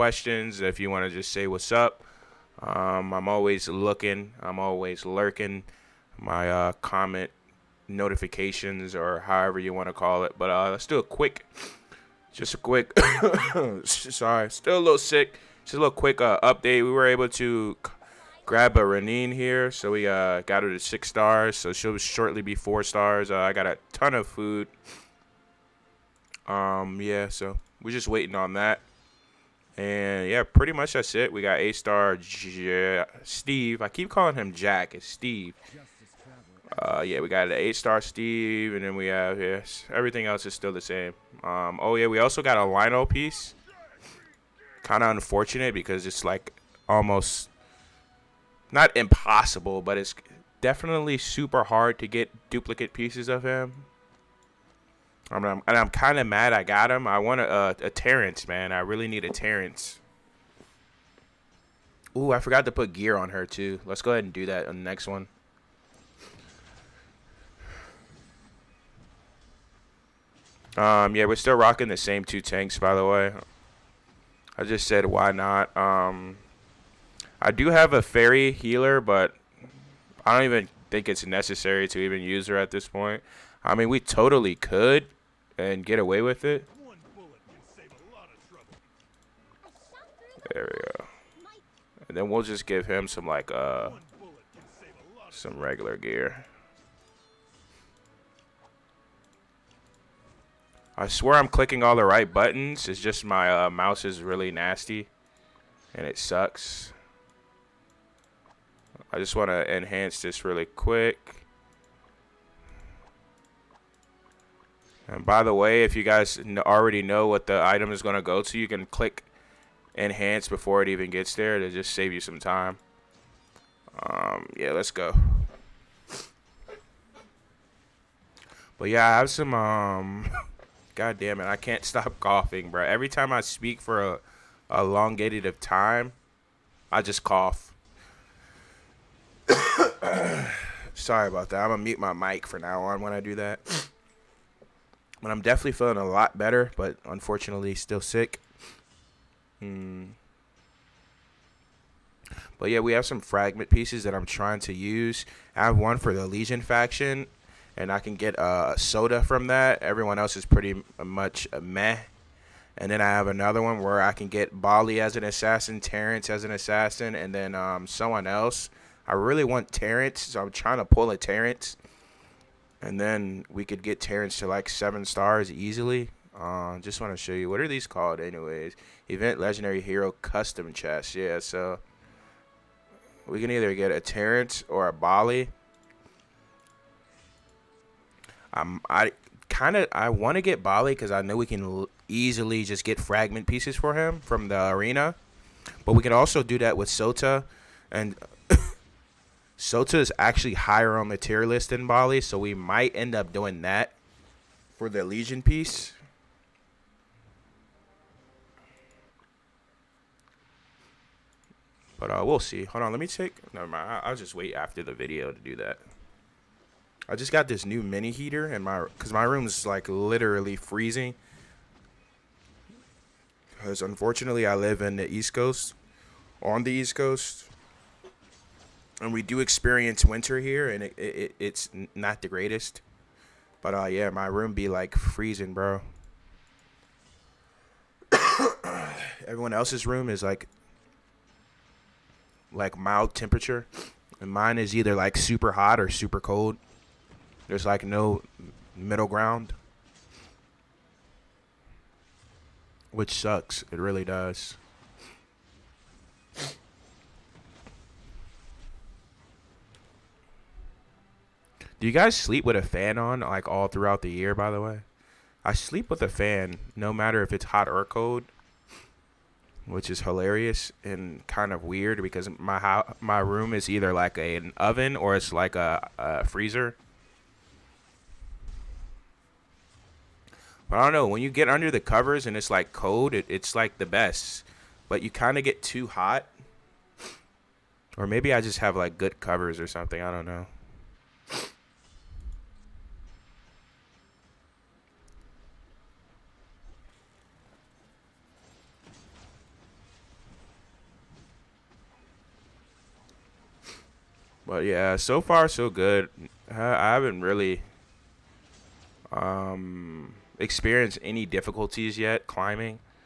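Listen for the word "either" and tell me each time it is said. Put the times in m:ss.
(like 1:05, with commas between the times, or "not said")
3:03, 4:04, 4:33.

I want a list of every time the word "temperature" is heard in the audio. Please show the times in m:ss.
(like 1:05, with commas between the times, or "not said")
4:03.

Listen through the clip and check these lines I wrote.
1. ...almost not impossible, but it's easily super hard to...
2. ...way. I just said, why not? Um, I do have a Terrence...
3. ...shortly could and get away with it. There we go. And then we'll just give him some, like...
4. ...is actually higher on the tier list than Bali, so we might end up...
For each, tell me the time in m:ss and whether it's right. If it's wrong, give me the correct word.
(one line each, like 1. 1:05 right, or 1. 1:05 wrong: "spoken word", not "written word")
1. 0:46 wrong: "definitely", not "easily"
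2. 1:13 wrong: "Fairy", not "Terrence"
3. 1:23 wrong: "totally", not "shortly"
4. 3:19 right.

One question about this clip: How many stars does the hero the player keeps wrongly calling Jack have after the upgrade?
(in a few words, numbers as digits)
8.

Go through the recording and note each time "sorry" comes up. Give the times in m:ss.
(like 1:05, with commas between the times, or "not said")
0:13, 2:20.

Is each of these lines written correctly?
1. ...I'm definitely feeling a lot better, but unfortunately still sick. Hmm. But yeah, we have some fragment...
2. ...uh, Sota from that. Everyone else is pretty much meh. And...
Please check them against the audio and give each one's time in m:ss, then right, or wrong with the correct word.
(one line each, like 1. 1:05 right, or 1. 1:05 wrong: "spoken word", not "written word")
1. 2:25 right
2. 2:38 right.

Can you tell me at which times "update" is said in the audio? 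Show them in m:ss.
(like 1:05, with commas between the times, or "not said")
0:16.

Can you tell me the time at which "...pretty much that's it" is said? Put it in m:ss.
0:30.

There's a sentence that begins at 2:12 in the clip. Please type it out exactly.
Every time I speak for a, a elongated of time, I just cough.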